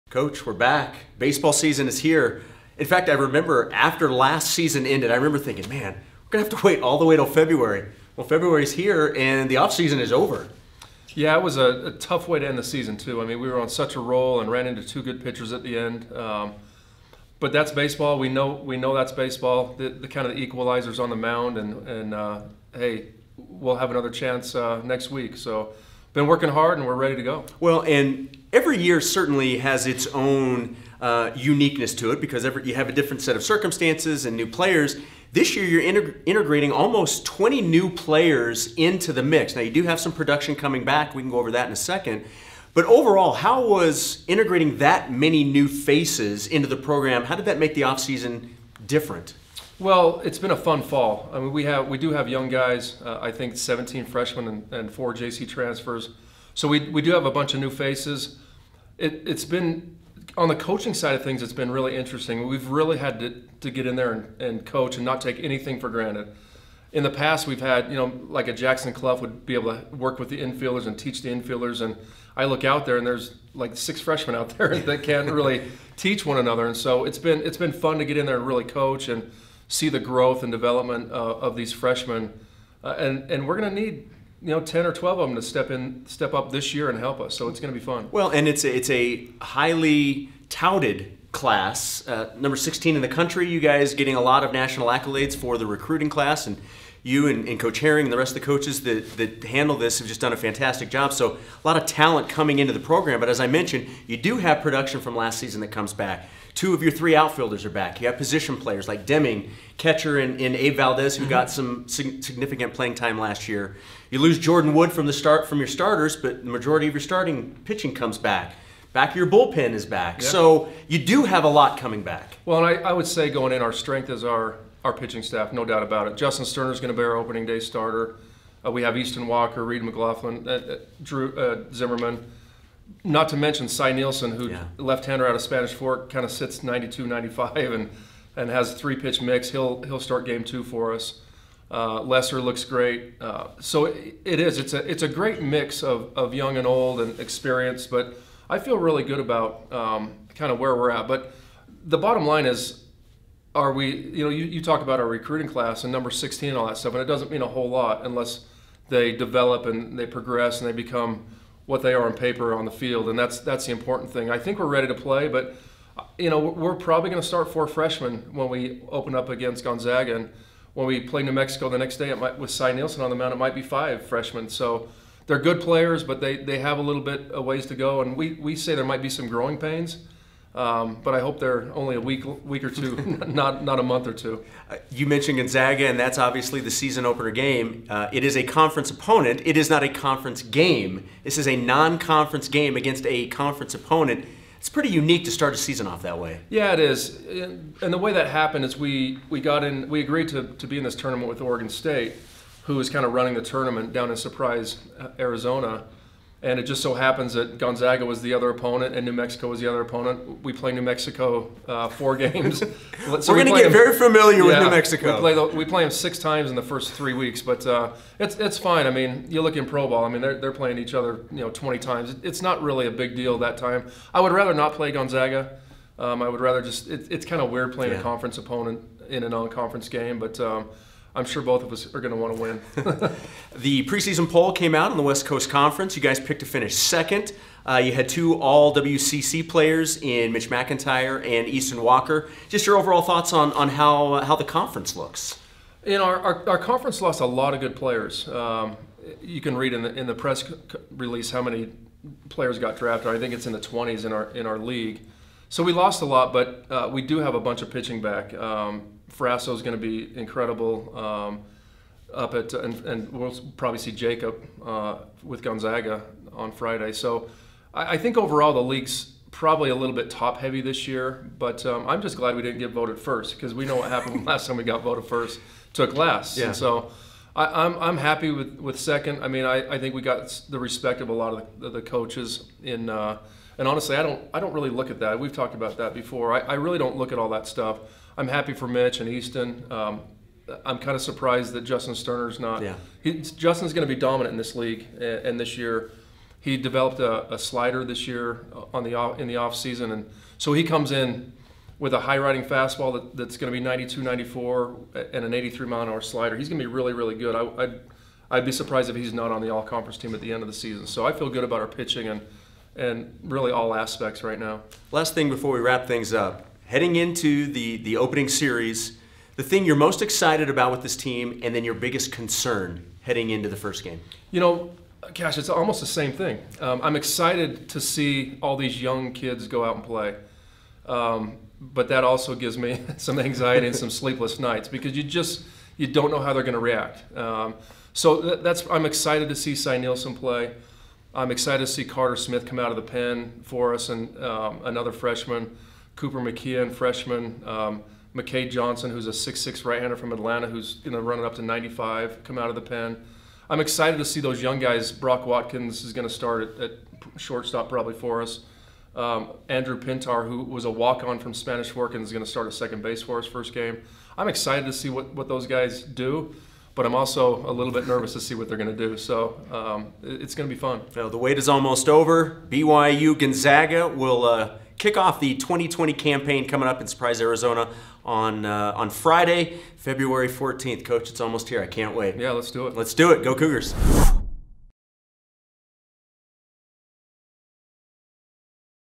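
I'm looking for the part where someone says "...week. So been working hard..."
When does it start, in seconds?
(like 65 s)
25 s.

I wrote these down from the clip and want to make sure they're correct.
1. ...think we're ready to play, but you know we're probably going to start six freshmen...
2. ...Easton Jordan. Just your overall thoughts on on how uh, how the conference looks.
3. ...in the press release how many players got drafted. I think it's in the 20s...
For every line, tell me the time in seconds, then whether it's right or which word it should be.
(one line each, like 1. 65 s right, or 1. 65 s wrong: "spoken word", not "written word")
1. 164 s wrong: "four", not "six"
2. 241 s wrong: "Walker", not "Jordan"
3. 249 s right.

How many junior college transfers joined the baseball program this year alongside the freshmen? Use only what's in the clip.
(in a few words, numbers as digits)
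4.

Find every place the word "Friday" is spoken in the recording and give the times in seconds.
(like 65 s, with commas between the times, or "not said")
266 s, 378 s.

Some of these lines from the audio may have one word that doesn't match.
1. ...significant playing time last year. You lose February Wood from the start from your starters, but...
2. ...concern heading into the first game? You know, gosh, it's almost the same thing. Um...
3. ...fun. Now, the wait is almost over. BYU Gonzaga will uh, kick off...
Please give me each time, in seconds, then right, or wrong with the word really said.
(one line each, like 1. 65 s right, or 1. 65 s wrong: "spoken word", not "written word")
1. 112 s wrong: "Jordan", not "February"
2. 322 s right
3. 370 s right.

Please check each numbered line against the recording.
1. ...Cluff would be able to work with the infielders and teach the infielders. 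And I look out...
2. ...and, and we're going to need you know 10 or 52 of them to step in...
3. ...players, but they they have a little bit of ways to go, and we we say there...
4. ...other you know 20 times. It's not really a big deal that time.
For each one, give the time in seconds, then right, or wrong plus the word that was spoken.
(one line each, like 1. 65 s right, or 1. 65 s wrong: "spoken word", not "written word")
1. 68 s right
2. 82 s wrong: "12", not "52"
3. 175 s right
4. 220 s right.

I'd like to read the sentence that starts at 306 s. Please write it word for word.
He's going to be really, really good.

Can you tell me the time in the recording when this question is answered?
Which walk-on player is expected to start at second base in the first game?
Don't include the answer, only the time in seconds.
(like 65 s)
359 s.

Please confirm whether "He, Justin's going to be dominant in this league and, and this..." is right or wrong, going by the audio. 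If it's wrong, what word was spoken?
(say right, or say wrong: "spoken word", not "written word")
right.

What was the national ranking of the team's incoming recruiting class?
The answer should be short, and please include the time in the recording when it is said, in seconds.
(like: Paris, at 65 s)
16, at 92 s.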